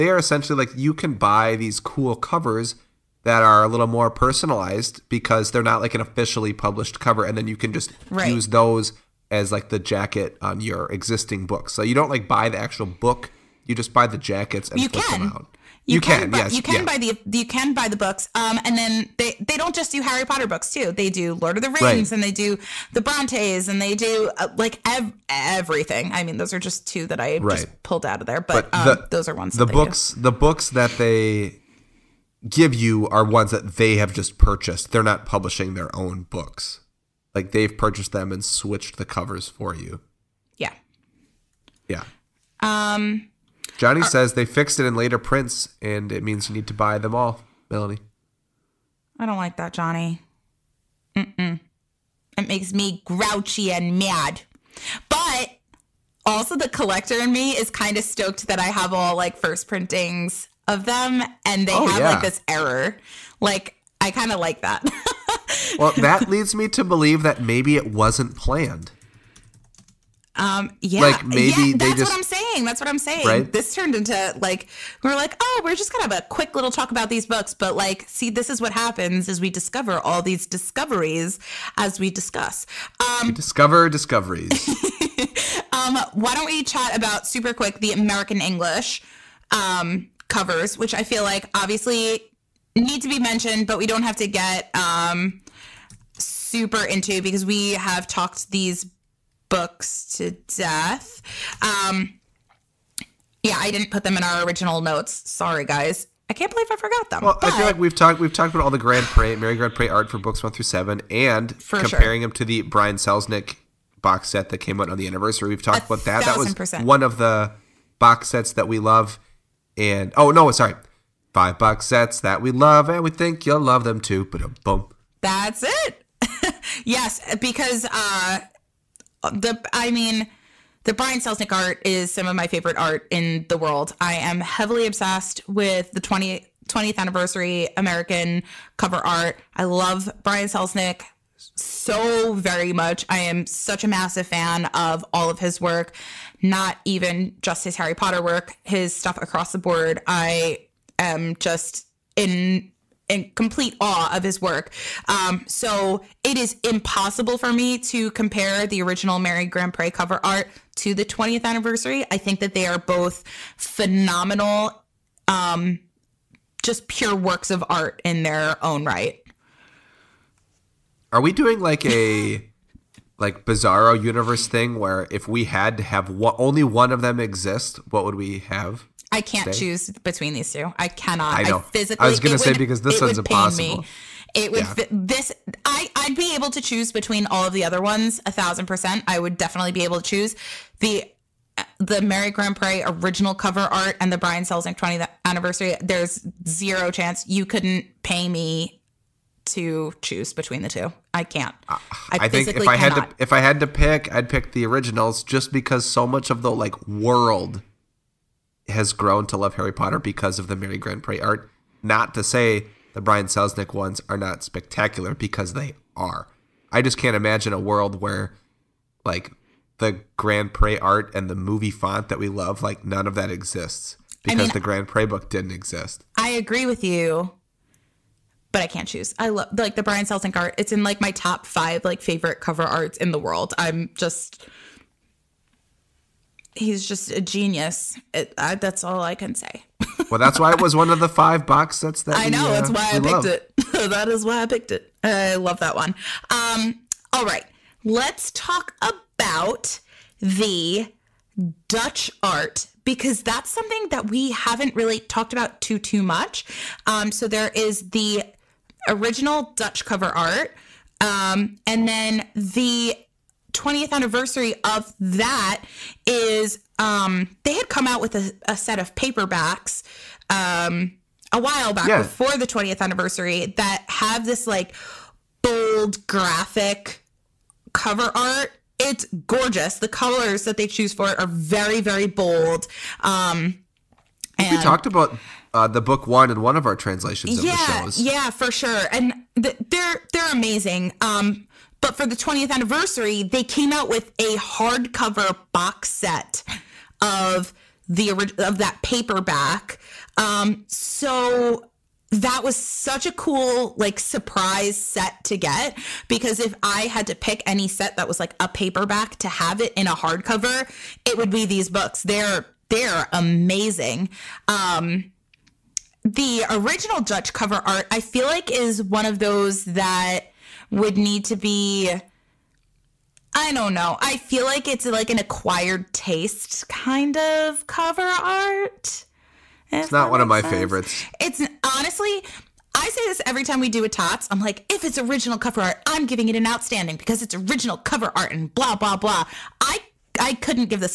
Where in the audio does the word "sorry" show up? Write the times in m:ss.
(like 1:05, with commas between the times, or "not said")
1:45, 2:00.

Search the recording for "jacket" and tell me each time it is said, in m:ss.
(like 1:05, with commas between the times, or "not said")
0:09, 0:14.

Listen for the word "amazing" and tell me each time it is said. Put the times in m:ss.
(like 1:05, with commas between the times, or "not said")
4:50, 5:13.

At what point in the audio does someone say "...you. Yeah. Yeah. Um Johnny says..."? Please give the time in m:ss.
0:39.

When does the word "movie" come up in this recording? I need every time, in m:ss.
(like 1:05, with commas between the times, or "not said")
3:41.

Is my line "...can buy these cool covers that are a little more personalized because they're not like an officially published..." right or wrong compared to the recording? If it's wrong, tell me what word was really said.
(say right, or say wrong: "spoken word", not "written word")
right.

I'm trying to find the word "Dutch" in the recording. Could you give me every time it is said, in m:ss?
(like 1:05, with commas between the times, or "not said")
4:11, 4:19, 5:16.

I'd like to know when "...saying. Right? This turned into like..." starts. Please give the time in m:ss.
1:12.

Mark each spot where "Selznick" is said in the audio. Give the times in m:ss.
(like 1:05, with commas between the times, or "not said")
1:52, 2:11, 2:20, 3:14, 3:33, 3:50.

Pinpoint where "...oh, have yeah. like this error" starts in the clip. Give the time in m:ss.
1:01.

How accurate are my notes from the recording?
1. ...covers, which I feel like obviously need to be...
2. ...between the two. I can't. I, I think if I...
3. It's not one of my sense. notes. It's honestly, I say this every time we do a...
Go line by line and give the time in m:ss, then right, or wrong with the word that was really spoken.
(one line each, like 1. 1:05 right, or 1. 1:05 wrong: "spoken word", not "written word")
1. 1:30 right
2. 3:20 right
3. 5:29 wrong: "favorites", not "notes".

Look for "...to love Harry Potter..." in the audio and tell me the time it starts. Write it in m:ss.
3:29.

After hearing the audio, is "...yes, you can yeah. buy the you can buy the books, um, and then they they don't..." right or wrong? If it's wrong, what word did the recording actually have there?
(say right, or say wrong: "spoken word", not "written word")
right.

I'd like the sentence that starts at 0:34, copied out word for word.
They're not publishing their own books.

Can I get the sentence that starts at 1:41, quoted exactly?
Um, yeah, I didn't put them in our original notes.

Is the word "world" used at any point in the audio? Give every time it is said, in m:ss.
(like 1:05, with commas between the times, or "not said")
2:13, 3:26, 3:37, 3:53.